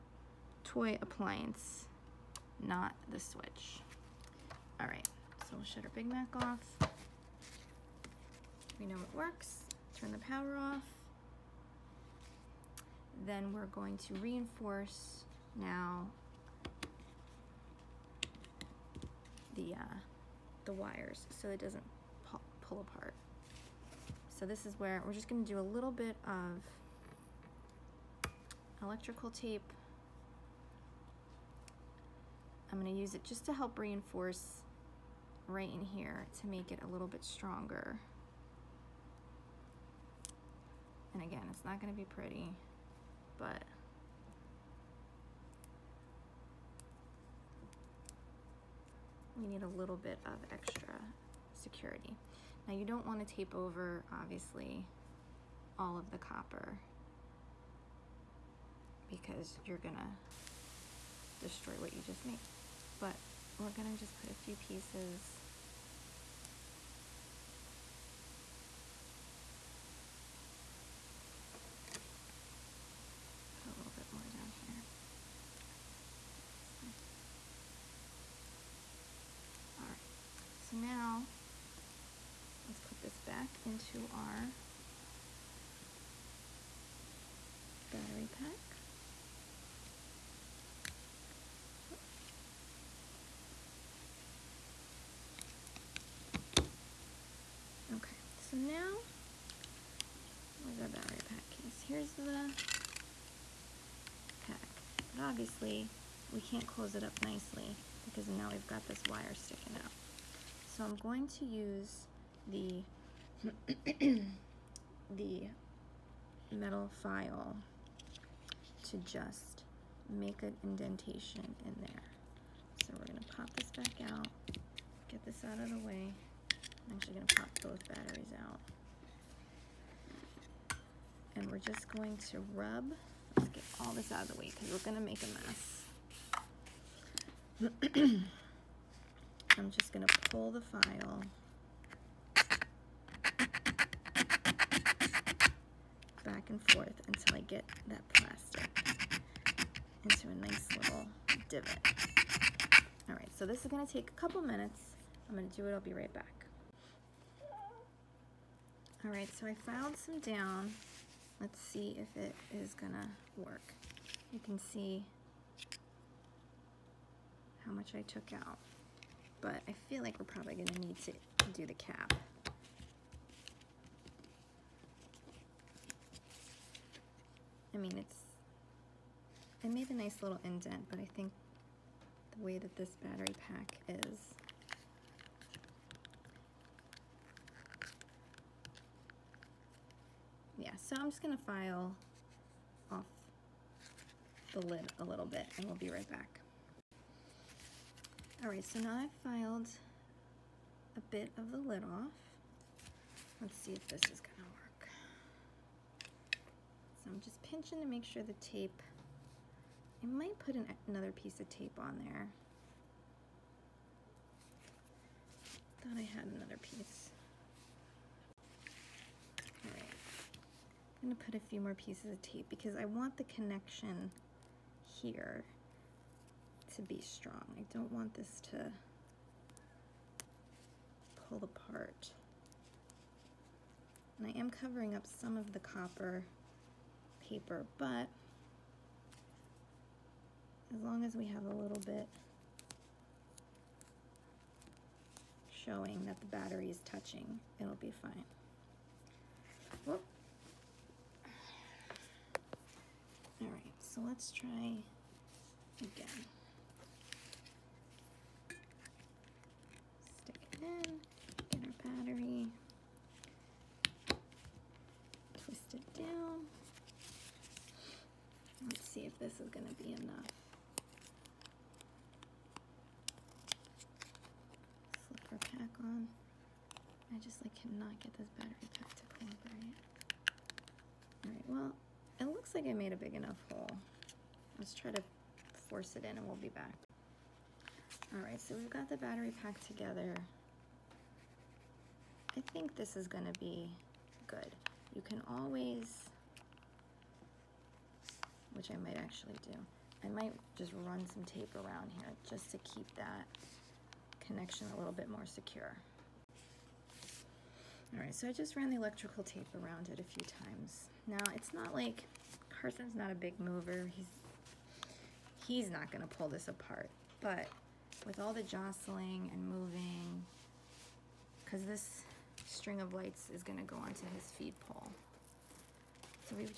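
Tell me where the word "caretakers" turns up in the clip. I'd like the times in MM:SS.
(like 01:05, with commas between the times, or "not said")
not said.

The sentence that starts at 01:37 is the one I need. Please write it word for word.
Okay, so now, where's our battery pack case?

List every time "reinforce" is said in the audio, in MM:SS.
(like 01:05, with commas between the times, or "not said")
00:14, 00:33.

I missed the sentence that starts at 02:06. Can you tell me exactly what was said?
I'm actually gonna pop both batteries out.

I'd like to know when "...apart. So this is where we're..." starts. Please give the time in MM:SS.
00:22.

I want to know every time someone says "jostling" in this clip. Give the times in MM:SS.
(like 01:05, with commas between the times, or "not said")
05:18.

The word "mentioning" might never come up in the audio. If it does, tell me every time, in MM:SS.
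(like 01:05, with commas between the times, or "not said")
not said.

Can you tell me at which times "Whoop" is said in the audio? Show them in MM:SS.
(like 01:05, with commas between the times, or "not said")
04:09.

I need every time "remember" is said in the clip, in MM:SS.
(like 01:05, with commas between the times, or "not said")
not said.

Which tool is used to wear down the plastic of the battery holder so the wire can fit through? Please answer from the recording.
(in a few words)
metal file.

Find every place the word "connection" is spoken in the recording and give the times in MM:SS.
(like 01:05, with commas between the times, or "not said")
03:43, 05:04.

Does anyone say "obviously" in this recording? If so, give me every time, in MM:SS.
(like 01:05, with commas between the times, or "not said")
00:54, 01:45.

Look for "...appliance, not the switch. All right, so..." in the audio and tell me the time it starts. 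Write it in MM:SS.
00:00.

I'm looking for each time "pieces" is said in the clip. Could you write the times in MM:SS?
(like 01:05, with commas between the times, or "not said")
01:04, 03:31, 03:36, 03:41.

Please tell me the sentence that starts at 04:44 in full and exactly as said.
Let's try to force it in and we'll be back.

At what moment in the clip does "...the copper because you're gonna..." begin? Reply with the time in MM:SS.
00:56.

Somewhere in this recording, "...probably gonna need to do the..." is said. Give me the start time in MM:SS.
02:50.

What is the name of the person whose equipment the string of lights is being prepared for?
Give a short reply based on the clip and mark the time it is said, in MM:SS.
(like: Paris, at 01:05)
Carson, at 05:12.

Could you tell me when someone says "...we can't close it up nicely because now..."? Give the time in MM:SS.
01:46.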